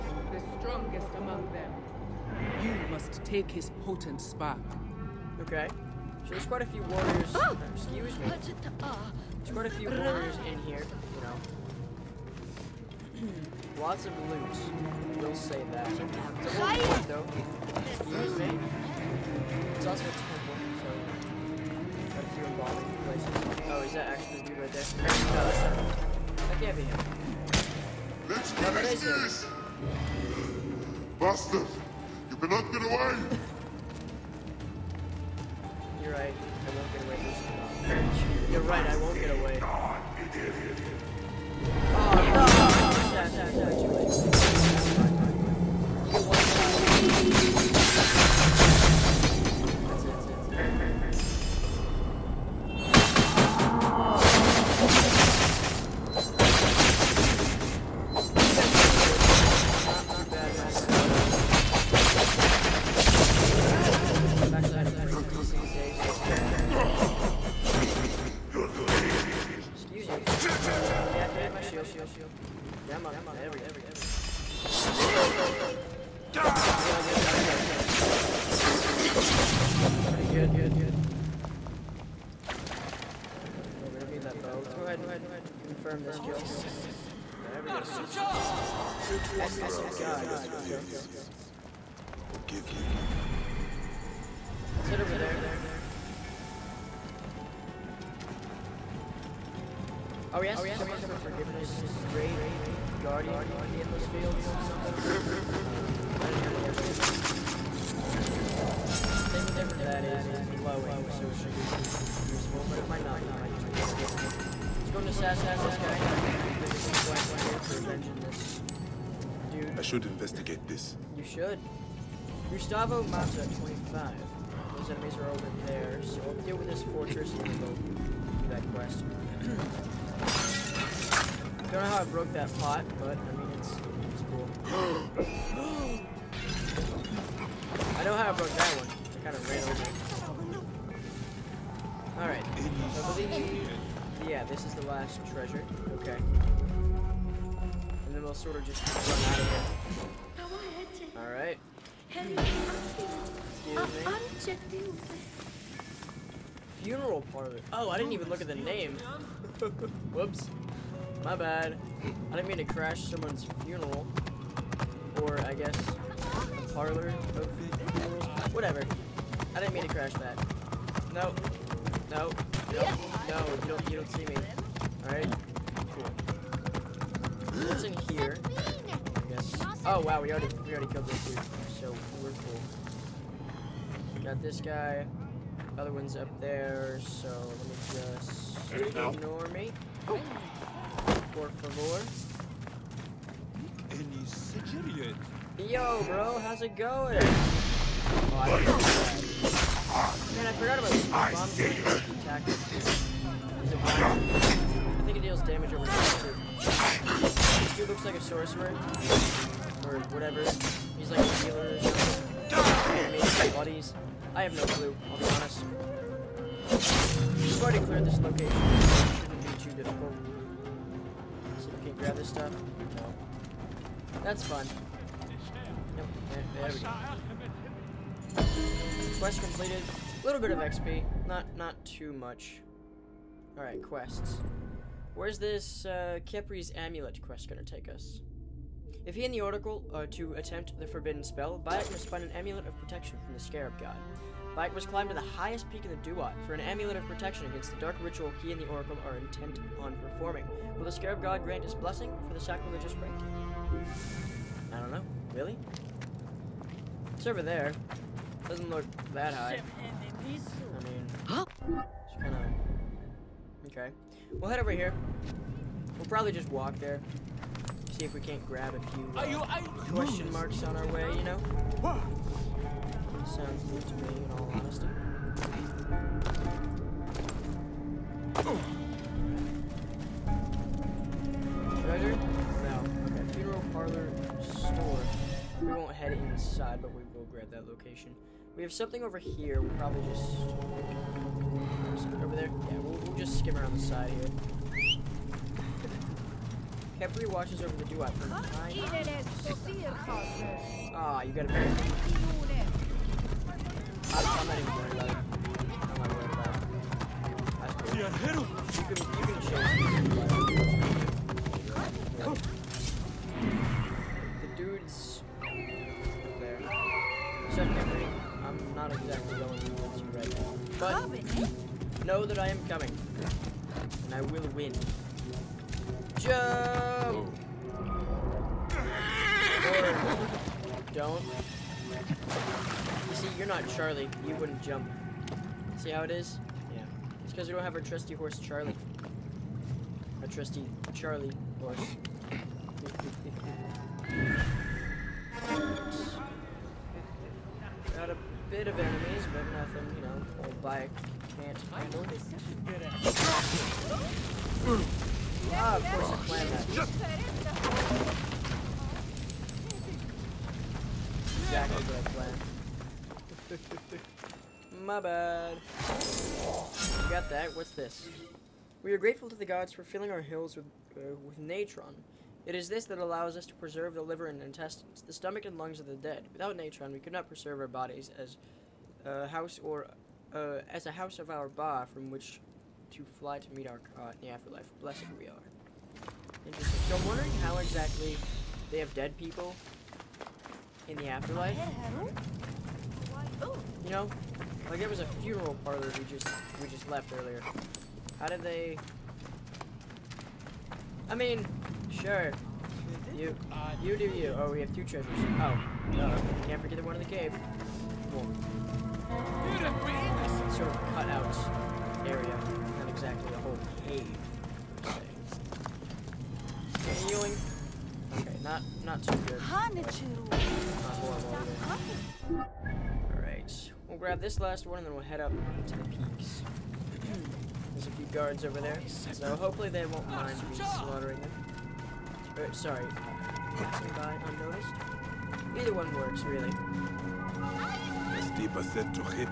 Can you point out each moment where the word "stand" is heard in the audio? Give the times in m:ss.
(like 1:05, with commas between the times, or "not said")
not said.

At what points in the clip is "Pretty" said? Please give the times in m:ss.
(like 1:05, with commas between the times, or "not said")
1:20.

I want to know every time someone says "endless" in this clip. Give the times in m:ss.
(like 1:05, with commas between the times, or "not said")
1:30, 1:43.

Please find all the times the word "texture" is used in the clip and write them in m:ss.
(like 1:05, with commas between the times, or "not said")
not said.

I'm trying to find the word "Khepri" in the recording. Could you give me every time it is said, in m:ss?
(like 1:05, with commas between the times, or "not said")
3:56, 4:57.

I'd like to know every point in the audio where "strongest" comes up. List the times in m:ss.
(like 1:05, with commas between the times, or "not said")
0:00.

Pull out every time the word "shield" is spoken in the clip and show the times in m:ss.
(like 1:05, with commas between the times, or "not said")
1:11.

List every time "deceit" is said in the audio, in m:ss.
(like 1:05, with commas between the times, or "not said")
not said.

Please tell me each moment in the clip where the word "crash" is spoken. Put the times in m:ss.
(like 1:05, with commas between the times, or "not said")
2:42, 2:49.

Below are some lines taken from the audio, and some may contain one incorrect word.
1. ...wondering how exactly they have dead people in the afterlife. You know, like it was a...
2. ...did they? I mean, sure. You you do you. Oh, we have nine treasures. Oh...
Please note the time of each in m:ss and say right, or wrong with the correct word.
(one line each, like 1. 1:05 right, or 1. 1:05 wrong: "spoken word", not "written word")
1. 6:27 right
2. 6:38 wrong: "two", not "nine".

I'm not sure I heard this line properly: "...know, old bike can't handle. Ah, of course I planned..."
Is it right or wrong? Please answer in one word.
right.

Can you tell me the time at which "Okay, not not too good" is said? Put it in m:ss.
6:58.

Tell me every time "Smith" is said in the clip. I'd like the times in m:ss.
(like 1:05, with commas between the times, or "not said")
not said.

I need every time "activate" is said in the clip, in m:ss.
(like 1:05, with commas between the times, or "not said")
1:11, 1:56.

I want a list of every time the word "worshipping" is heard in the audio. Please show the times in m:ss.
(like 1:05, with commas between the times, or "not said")
not said.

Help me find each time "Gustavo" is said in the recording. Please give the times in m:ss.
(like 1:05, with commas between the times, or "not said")
2:02.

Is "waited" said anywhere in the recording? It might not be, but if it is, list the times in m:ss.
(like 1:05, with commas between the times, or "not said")
not said.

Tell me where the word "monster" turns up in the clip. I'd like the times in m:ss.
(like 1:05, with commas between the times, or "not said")
not said.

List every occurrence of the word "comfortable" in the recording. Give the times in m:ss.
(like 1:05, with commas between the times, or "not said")
not said.